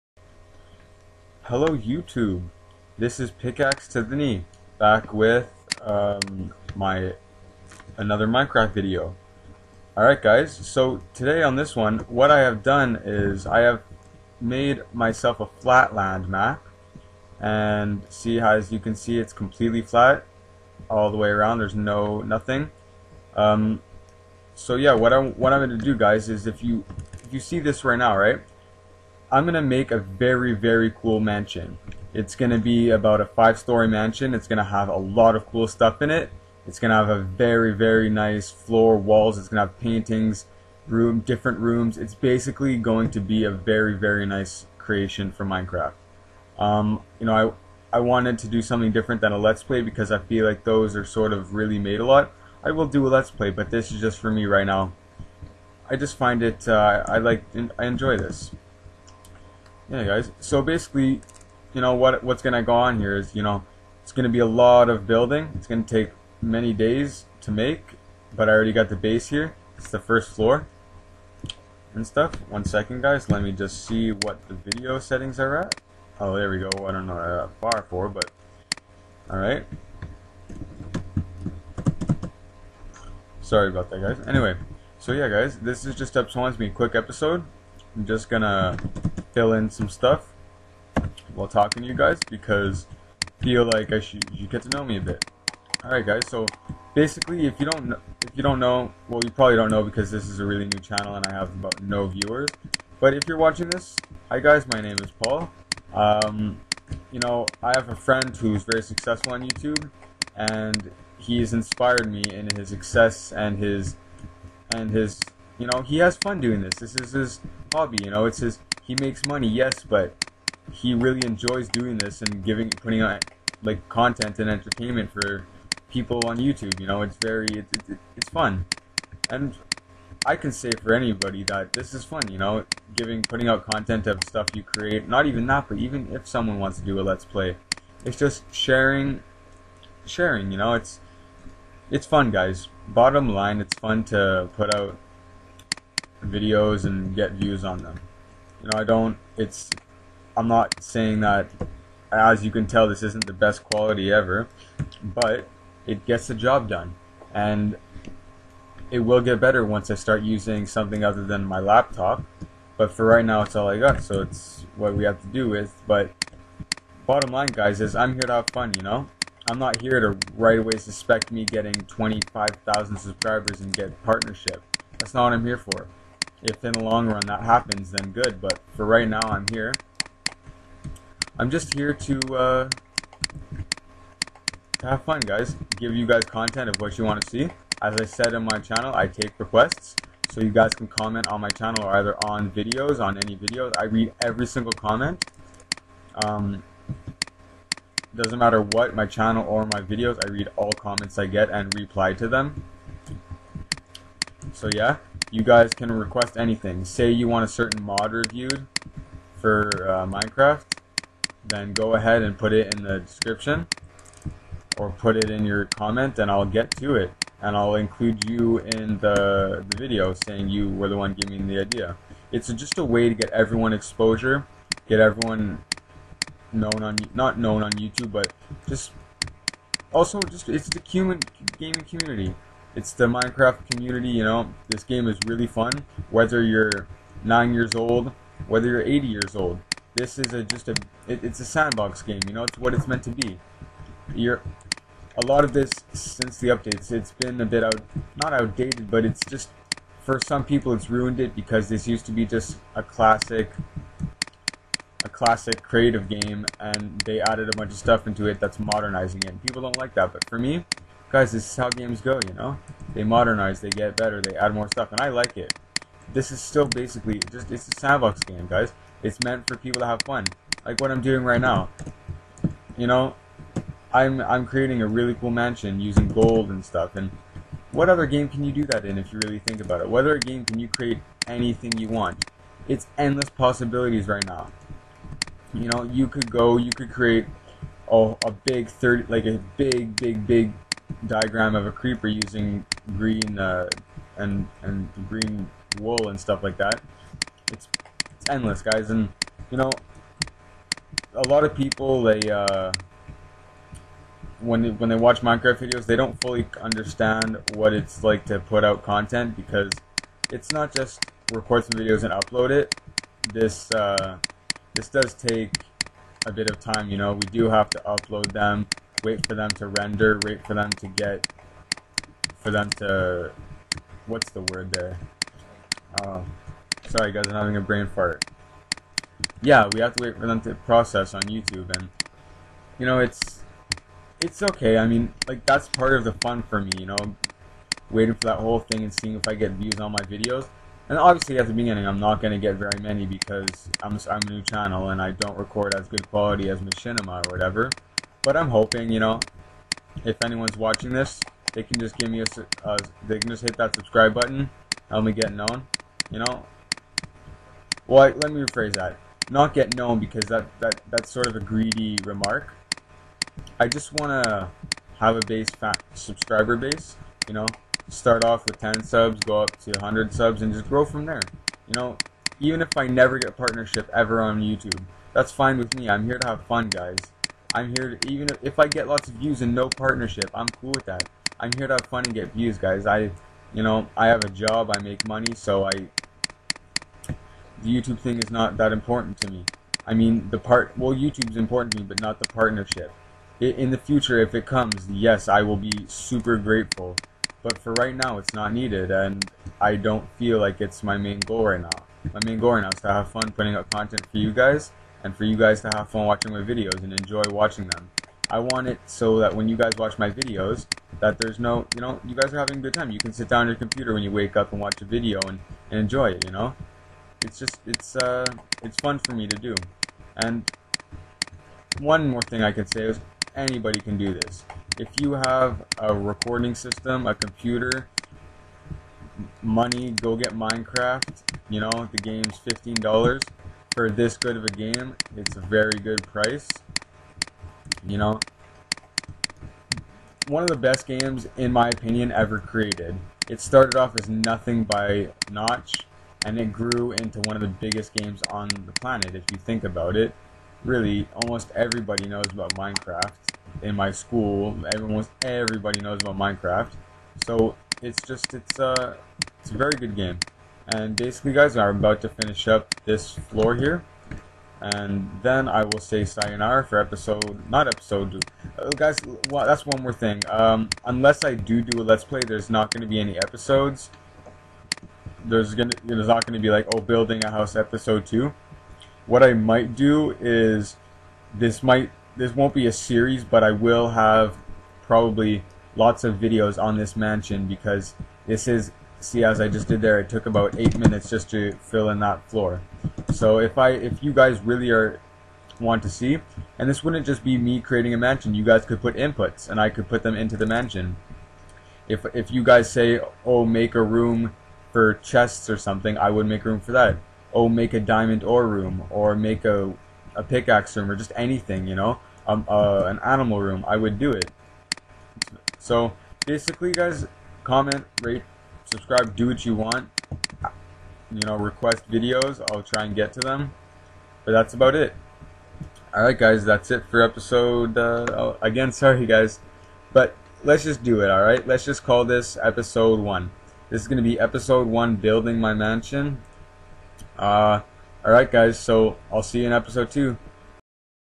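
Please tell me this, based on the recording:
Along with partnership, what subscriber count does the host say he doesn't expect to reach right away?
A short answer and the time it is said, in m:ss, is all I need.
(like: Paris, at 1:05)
25,000, at 2:51.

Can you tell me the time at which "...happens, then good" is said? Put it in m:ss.
2:57.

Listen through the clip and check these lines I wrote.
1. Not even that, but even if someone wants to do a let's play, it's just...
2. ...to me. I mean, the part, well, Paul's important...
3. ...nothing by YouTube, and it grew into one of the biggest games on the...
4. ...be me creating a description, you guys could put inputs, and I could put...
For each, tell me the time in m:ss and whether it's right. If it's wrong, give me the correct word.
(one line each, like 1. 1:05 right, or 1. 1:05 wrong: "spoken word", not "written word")
1. 2:15 right
2. 6:29 wrong: "YouTube", not "Paul"
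3. 7:24 wrong: "Notch", not "YouTube"
4. 8:17 wrong: "mansion", not "description".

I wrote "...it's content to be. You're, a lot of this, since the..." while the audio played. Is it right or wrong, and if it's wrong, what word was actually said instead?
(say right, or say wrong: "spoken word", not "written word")
wrong: "meant", not "content".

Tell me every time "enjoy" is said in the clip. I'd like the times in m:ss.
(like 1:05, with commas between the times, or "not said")
0:57, 2:01, 6:46, 6:55.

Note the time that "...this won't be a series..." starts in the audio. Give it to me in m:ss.
8:02.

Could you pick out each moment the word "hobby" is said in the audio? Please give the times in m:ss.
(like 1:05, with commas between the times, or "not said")
1:57.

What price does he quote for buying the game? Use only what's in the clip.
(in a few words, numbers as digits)
$15.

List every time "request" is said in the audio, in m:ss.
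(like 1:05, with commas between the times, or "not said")
3:09, 3:25, 8:41.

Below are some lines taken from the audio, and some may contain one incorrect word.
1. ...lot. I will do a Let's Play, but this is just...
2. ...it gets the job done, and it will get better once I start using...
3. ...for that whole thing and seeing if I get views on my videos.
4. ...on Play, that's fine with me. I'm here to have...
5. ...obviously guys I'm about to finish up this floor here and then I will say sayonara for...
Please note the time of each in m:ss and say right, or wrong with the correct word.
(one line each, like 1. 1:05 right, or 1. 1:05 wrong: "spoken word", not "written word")
1. 0:52 right
2. 2:35 right
3. 5:38 right
4. 6:14 wrong: "YouTube", not "Play"
5. 7:40 wrong: "basically", not "obviously".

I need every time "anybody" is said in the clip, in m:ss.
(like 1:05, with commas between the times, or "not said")
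2:10, 7:03.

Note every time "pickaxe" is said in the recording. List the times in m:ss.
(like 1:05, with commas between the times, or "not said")
0:03, 8:30.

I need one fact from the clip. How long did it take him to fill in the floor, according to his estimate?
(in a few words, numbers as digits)
8 minutes.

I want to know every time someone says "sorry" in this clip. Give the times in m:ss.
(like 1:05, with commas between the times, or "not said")
1:23, 5:26, 8:48.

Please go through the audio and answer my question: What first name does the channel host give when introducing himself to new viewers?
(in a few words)
Paul.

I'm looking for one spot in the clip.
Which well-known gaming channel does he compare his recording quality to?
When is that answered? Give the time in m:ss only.
5:46.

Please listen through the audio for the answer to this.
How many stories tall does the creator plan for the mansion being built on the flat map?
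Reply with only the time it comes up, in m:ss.
0:33.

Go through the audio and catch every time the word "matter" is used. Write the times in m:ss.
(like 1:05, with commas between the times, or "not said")
3:18.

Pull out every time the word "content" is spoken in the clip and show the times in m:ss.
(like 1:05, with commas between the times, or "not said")
2:03, 2:13, 3:06, 5:08, 6:43.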